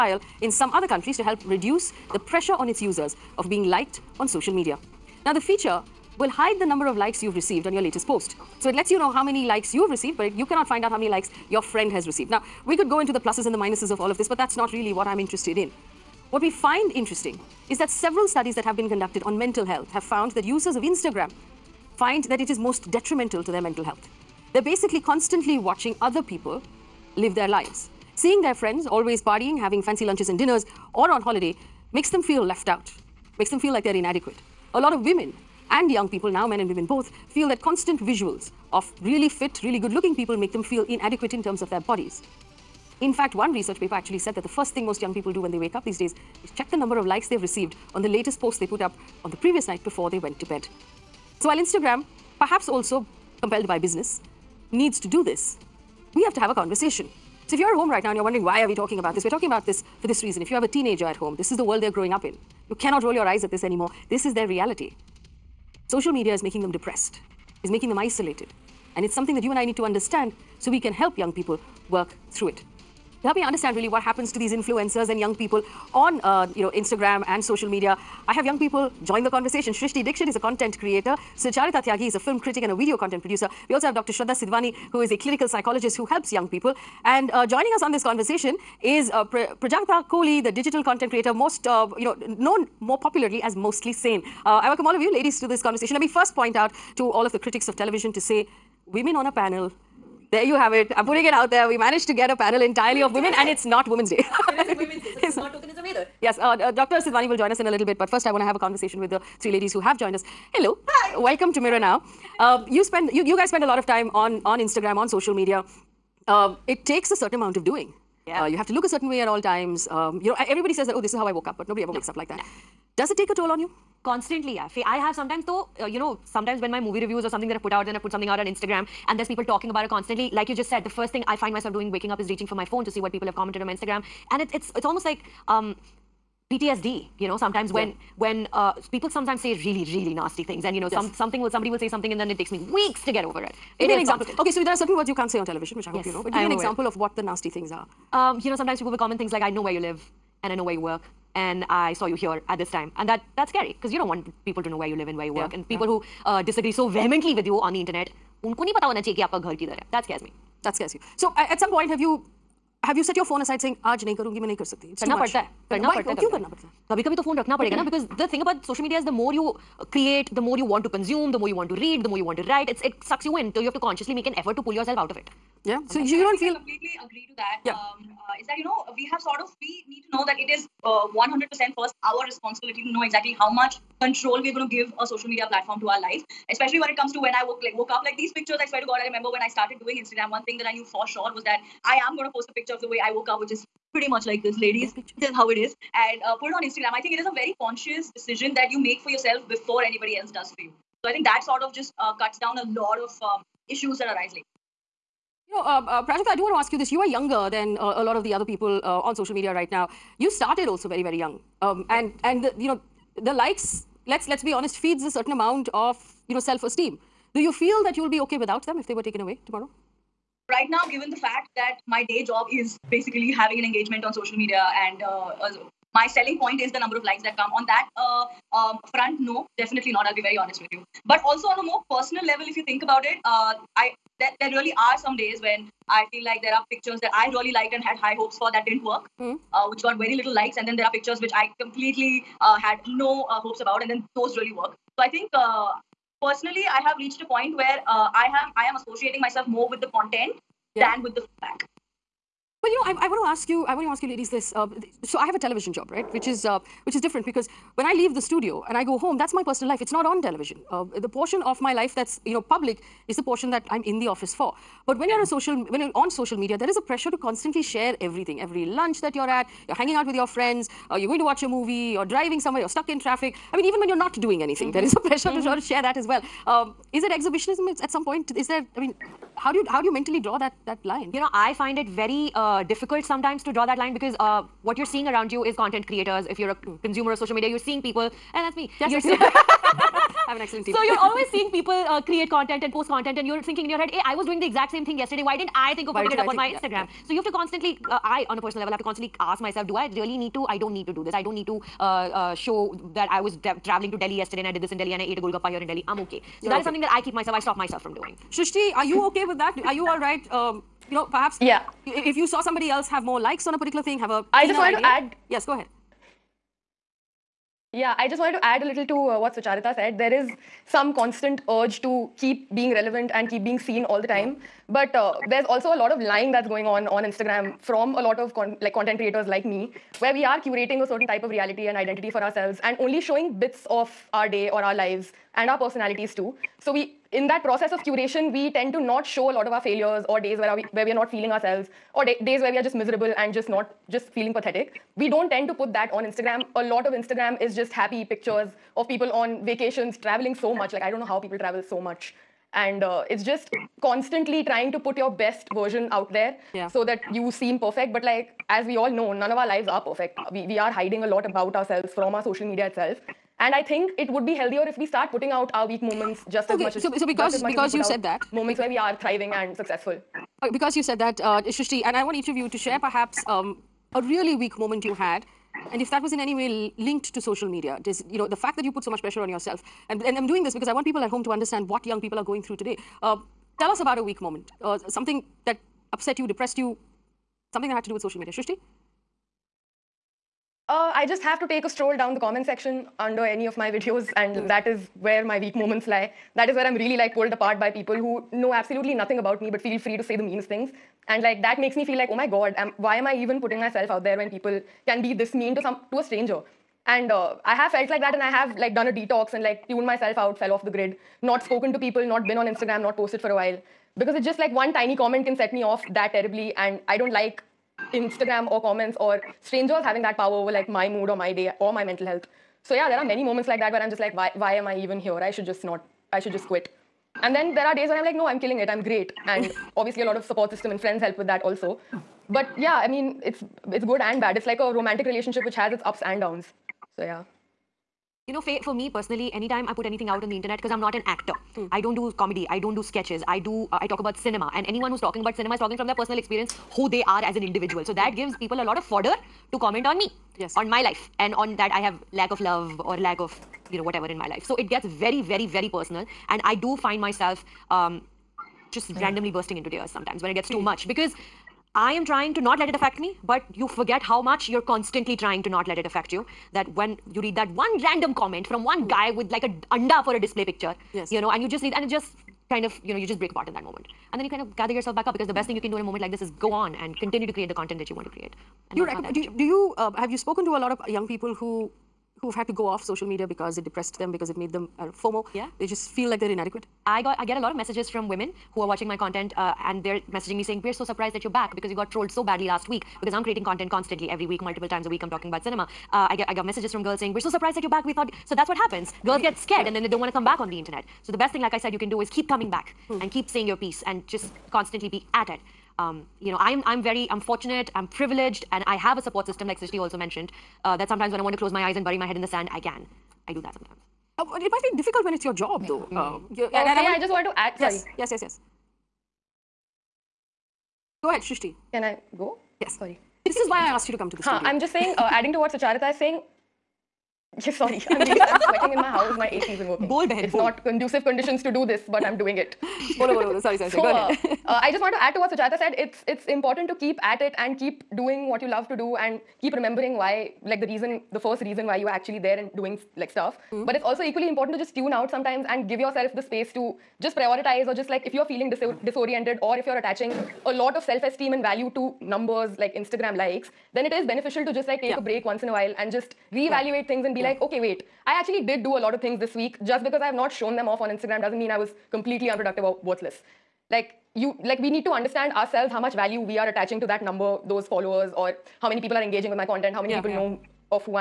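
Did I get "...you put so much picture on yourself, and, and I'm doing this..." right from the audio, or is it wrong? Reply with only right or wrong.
wrong.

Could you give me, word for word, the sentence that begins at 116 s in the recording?
Um, it takes a certain amount of doing.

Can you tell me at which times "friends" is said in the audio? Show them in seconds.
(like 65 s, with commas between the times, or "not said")
11 s, 28 s, 270 s, 430 s.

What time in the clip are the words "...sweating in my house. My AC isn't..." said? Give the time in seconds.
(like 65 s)
528 s.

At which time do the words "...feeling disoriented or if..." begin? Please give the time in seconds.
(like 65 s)
548 s.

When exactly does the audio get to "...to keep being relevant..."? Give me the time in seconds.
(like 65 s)
321 s.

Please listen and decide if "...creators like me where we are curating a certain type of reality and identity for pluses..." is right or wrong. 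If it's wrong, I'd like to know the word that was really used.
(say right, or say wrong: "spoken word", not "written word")
wrong: "ourselves", not "pluses".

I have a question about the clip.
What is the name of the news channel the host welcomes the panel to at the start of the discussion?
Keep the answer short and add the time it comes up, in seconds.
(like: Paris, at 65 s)
Mirror Now, at 111 s.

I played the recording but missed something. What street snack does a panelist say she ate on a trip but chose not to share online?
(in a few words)
Golgappa.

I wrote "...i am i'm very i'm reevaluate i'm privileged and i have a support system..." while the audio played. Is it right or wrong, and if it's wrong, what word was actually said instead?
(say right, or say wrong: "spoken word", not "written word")
wrong: "fortunate", not "reevaluate".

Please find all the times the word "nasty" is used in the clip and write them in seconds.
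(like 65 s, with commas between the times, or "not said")
140 s, 147 s.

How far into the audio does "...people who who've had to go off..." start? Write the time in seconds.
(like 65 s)
481 s.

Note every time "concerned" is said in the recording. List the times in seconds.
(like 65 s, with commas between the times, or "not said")
not said.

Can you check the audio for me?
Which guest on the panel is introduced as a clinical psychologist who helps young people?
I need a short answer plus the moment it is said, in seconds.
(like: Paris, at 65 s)
Dr. Shraddha Sidwani, at 83 s.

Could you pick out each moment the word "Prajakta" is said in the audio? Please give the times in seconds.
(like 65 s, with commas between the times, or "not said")
89 s, 206 s.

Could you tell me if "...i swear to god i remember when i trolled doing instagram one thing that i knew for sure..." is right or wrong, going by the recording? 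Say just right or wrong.
wrong.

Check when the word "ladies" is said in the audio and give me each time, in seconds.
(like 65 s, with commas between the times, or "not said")
95 s, 109 s, 194 s, 254 s.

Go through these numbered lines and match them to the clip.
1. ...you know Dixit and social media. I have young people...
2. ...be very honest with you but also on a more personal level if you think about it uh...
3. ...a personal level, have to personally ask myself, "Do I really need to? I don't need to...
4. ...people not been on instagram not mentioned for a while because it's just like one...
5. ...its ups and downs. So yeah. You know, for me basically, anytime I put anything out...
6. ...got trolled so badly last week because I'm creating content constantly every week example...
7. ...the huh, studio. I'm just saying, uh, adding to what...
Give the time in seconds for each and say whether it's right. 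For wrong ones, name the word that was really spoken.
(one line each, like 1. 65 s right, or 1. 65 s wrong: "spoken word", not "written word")
1. 76 s wrong: "Instagram", not "Dixit"
2. 230 s right
3. 298 s wrong: "constantly", not "personally"
4. 411 s wrong: "posted", not "mentioned"
5. 435 s wrong: "personally", not "basically"
6. 491 s wrong: "multiple", not "example"
7. 524 s right.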